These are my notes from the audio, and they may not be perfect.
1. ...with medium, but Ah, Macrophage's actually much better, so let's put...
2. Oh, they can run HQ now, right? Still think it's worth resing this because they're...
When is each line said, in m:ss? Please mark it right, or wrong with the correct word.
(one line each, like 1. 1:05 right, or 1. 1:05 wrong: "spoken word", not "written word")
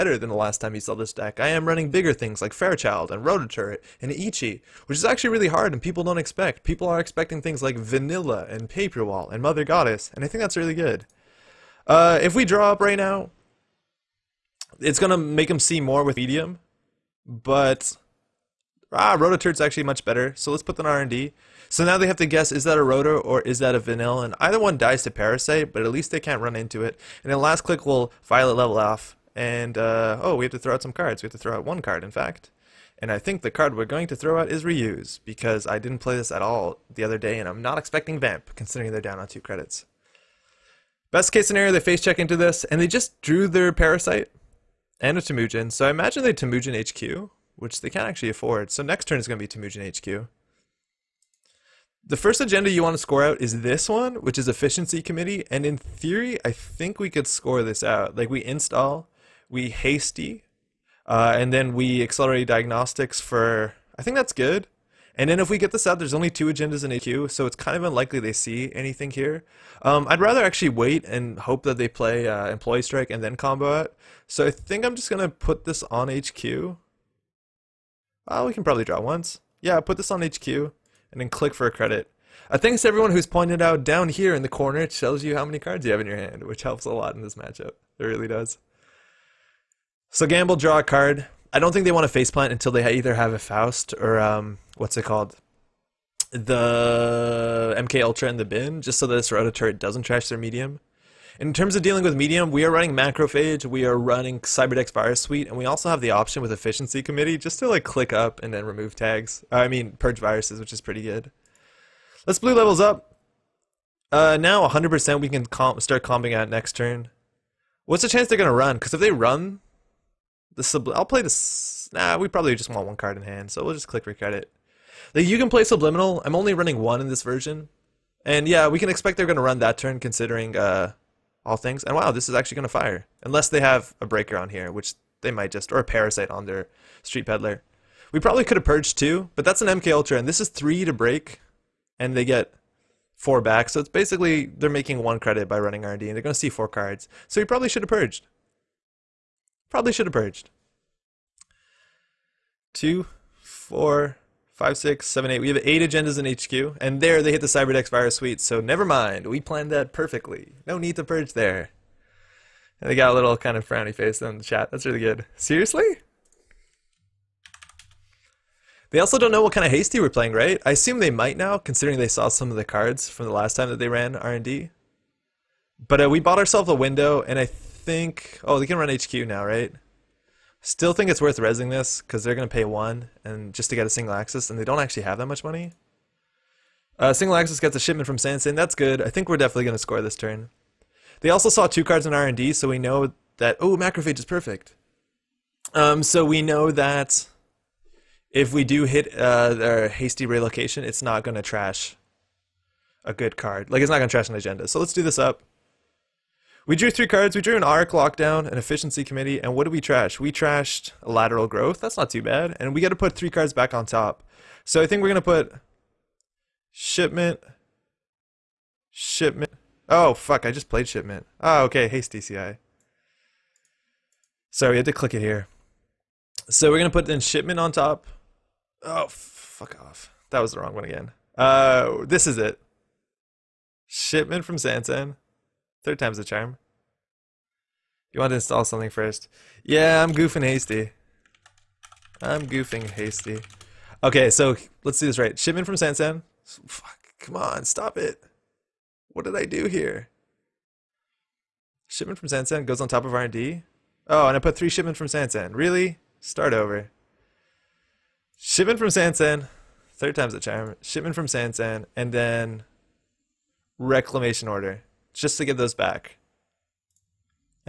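1. 0:16 wrong: "Rototurret", not "Macrophage"
2. 2:58 right.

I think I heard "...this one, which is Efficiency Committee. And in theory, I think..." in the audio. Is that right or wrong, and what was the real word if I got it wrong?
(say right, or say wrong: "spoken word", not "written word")
right.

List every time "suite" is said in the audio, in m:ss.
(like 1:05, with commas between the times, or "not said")
1:45, 2:38.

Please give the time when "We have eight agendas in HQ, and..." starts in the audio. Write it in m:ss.
2:35.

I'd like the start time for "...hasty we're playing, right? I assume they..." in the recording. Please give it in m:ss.
2:49.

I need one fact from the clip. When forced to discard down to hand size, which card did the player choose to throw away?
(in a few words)
Reuse.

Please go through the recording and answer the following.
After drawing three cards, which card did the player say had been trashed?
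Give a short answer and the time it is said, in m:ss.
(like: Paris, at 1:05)
Lateral Growth, at 3:31.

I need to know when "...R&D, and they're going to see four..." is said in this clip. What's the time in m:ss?
2:25.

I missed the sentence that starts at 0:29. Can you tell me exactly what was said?
And, uh, oh, we have to throw out some cards.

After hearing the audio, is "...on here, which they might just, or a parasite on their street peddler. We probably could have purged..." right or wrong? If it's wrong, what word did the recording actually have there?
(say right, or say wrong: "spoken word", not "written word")
right.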